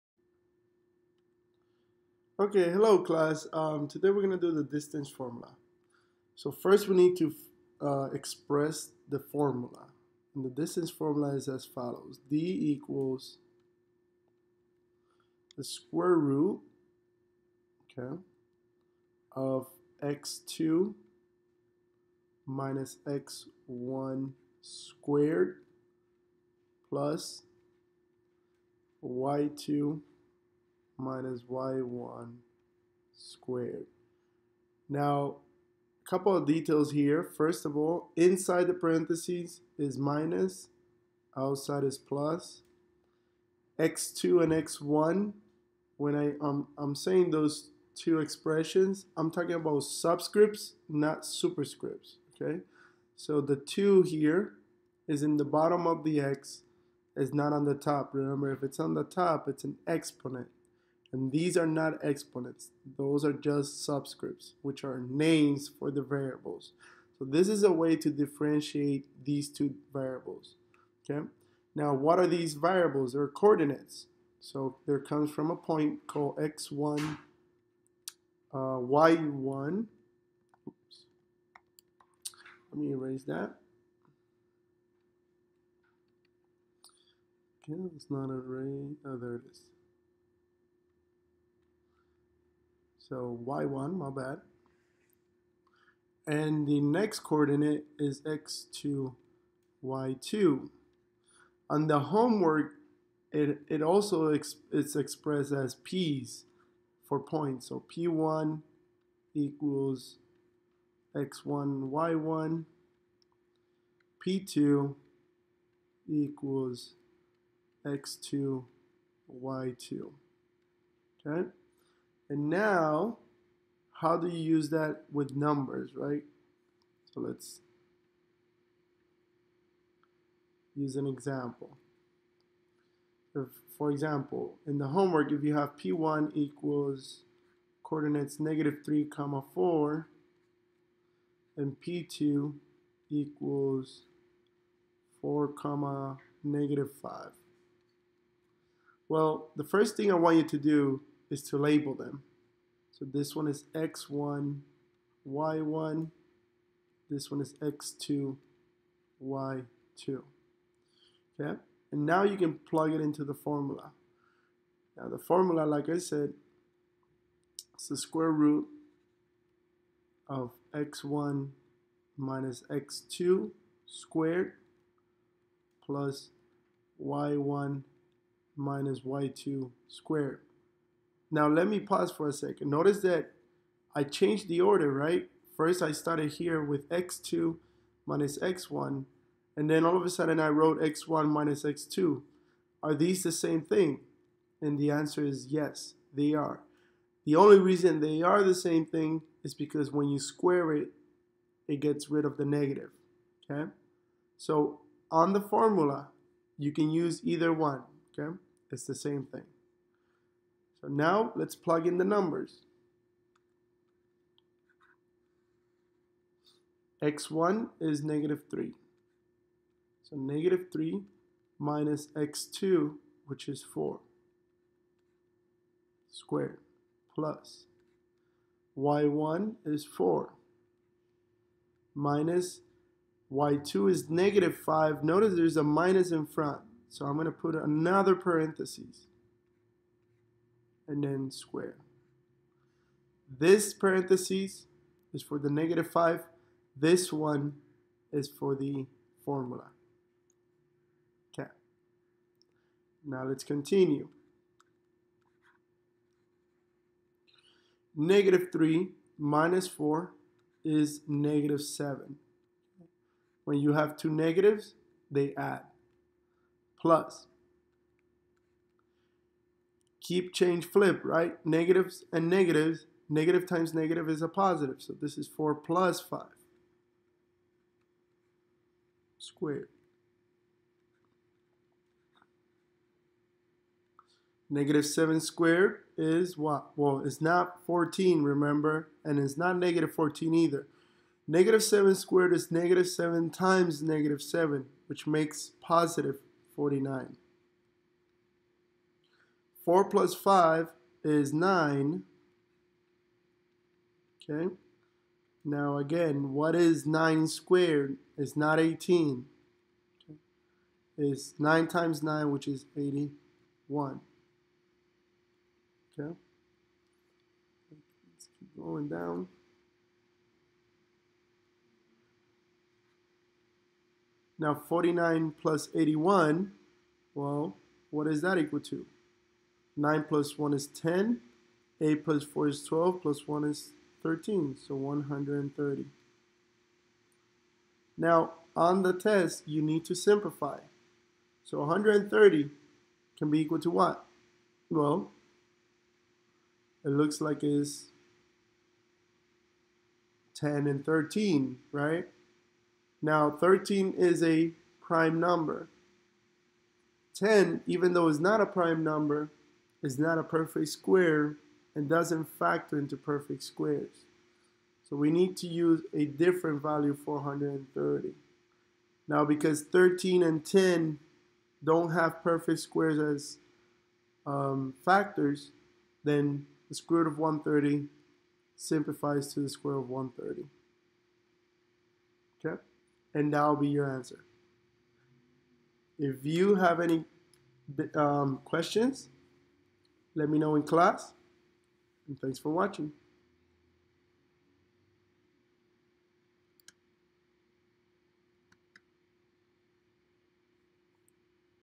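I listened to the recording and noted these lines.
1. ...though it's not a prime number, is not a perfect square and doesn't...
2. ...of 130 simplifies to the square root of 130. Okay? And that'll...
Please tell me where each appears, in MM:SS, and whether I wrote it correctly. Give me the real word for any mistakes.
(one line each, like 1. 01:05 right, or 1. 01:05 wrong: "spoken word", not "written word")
1. 05:57 right
2. 06:17 right.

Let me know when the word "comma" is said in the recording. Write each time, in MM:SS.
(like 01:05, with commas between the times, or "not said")
02:19, 02:25.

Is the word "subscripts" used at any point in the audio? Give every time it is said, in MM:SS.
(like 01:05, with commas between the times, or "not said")
00:49, 01:03.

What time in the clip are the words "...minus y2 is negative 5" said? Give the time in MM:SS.
03:51.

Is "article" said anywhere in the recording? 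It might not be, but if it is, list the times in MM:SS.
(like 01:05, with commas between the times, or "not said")
not said.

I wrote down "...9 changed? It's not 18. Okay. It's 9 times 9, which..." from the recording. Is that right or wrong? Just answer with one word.
wrong.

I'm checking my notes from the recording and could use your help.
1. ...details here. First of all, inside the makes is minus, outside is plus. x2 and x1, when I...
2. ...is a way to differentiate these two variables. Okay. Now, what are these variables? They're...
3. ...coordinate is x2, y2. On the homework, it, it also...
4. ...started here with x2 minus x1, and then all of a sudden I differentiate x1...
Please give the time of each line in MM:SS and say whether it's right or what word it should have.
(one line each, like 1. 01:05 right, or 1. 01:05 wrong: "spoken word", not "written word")
1. 00:36 wrong: "parentheses", not "makes"
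2. 01:07 right
3. 01:37 right
4. 03:05 wrong: "wrote", not "differentiate".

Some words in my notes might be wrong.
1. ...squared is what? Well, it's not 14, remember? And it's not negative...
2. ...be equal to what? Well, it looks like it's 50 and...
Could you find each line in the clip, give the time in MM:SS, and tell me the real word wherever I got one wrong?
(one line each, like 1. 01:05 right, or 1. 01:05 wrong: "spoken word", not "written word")
1. 04:45 right
2. 05:43 wrong: "10", not "50".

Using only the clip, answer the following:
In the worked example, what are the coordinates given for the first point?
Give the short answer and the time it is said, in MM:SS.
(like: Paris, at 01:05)
-3, 4, at 02:18.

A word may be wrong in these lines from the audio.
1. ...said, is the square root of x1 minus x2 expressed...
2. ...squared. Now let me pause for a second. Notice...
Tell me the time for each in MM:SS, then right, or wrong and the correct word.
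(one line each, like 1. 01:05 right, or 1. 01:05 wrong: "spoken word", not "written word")
1. 02:45 wrong: "squared", not "expressed"
2. 02:59 right.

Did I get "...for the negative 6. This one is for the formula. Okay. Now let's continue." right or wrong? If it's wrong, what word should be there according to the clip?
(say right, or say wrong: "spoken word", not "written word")
wrong: "5", not "6".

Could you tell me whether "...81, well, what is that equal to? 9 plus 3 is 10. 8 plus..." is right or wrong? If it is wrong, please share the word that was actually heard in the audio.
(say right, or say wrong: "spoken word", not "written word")
wrong: "1", not "3".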